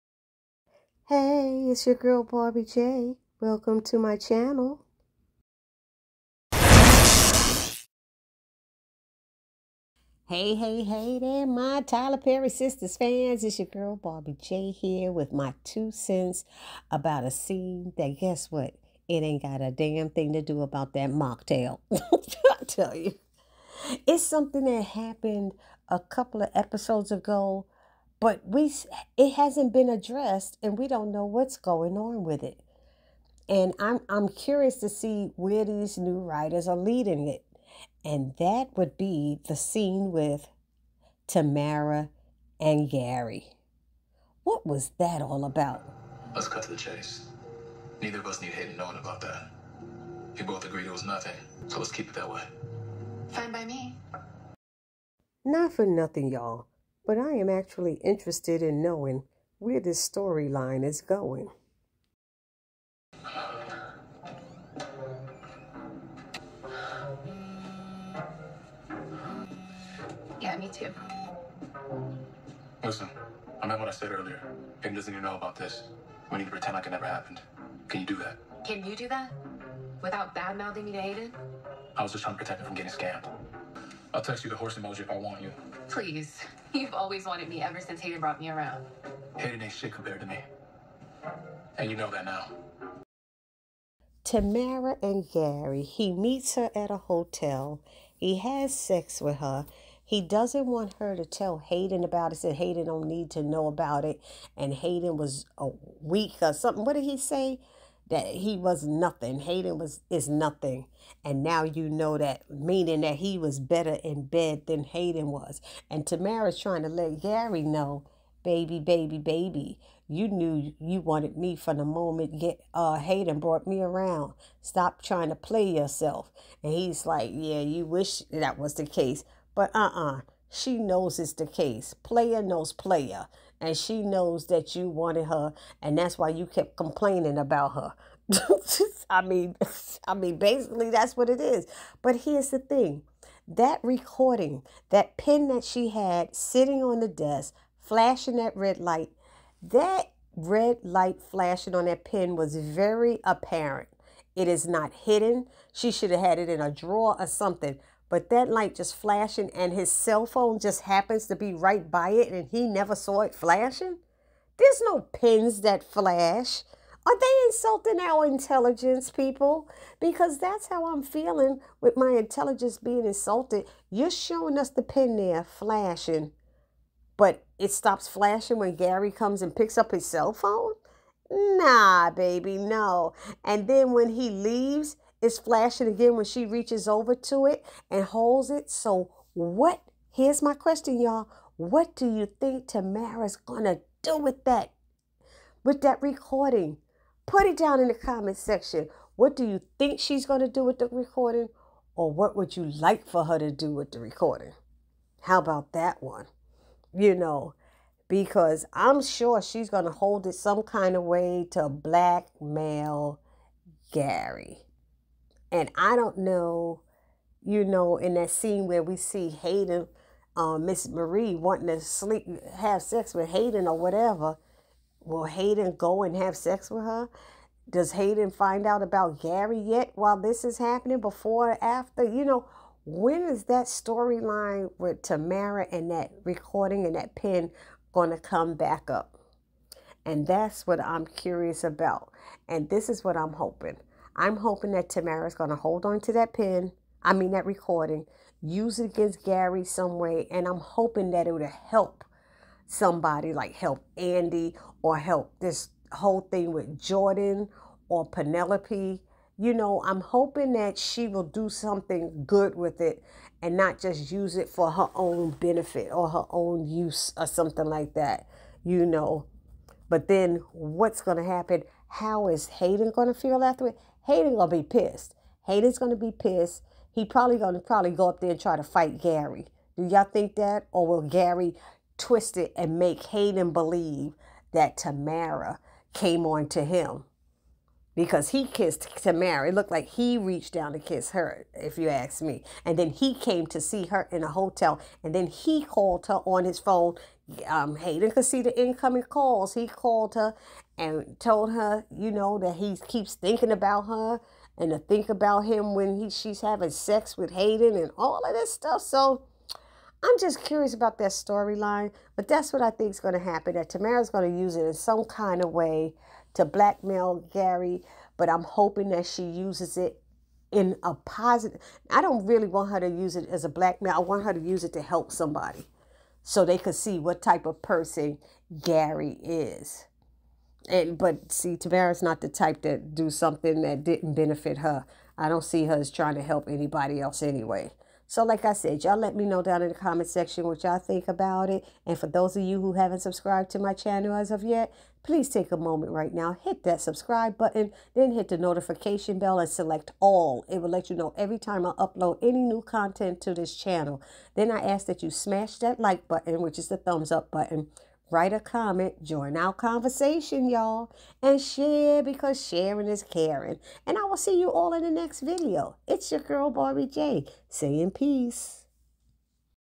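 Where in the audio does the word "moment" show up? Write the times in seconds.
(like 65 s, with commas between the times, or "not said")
121 s, 345 s.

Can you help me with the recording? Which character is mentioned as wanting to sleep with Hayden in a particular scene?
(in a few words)
Miss Marie.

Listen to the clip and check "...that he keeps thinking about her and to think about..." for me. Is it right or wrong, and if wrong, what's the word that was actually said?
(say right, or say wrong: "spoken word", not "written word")
right.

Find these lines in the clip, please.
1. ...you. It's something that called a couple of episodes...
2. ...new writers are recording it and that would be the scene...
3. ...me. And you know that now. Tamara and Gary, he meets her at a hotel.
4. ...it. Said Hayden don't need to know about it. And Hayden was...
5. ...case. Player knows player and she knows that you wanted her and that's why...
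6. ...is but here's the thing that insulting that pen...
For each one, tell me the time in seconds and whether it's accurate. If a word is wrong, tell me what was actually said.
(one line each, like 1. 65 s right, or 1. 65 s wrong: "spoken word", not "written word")
1. 22 s wrong: "happened", not "called"
2. 35 s wrong: "leading", not "recording"
3. 90 s right
4. 102 s right
5. 131 s right
6. 141 s wrong: "recording", not "insulting".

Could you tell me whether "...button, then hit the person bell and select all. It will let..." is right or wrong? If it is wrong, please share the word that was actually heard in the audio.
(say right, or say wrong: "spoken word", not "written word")
wrong: "notification", not "person".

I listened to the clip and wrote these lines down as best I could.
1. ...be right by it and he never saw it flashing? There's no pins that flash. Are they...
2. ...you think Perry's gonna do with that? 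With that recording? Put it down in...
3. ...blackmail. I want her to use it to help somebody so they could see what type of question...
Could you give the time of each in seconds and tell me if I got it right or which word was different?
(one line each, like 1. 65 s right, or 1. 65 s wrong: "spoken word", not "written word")
1. 161 s right
2. 192 s wrong: "Tamara", not "Perry"
3. 323 s wrong: "person", not "question".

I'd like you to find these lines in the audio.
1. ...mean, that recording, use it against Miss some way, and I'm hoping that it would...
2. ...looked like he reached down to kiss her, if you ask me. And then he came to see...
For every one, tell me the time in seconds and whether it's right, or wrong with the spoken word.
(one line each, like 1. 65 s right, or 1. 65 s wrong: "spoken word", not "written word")
1. 247 s wrong: "Gary", not "Miss"
2. 289 s right.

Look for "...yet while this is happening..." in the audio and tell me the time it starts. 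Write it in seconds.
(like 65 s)
229 s.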